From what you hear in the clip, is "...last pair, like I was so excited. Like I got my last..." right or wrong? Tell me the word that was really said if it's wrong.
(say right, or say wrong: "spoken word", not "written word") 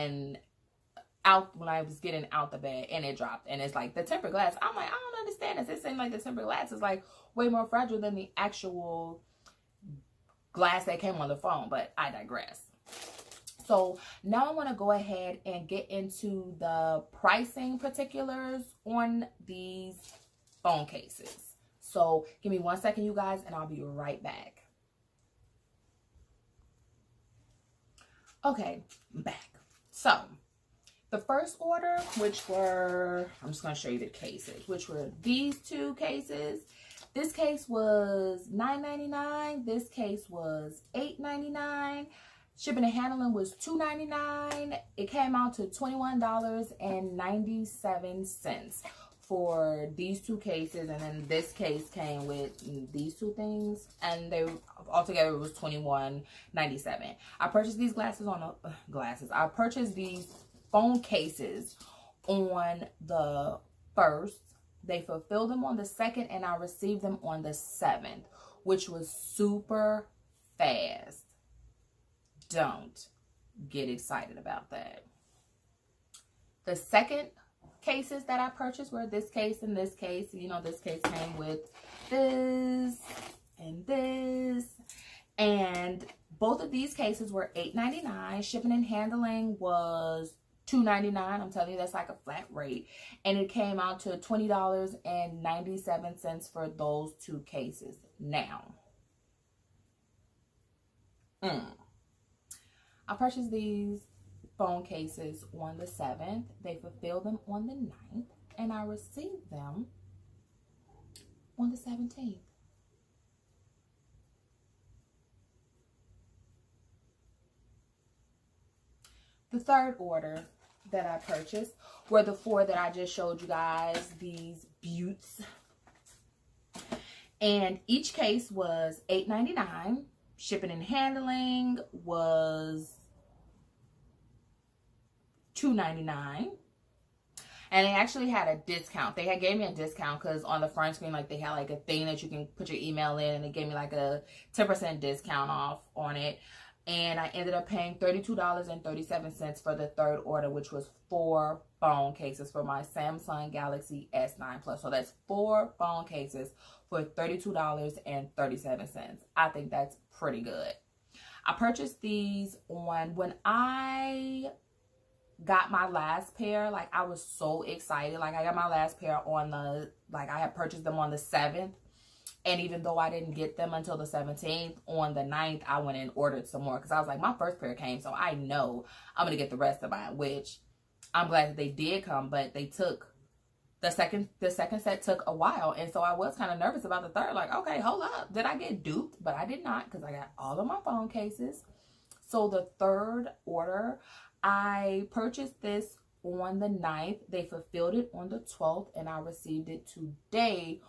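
right.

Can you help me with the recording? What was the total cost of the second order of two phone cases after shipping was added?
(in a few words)
$20.97.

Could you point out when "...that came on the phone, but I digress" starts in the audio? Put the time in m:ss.
0:10.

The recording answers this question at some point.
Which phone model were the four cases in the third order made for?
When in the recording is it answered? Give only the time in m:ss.
2:32.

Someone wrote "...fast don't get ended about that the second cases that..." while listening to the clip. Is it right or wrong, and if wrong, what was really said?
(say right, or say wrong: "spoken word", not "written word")
wrong: "excited", not "ended".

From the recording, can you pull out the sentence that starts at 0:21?
So give me one second, you guys, and I'll be right back.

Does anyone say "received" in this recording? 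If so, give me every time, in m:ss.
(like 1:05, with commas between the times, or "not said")
1:06, 1:48, 3:19.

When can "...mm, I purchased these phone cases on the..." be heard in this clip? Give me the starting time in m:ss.
1:41.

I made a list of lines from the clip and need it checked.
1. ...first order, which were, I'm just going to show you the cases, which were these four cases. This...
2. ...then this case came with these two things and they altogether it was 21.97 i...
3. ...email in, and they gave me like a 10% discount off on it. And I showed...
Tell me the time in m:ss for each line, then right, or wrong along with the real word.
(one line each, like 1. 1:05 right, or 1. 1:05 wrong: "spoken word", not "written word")
1. 0:31 wrong: "two", not "four"
2. 0:50 right
3. 2:22 wrong: "ended", not "showed".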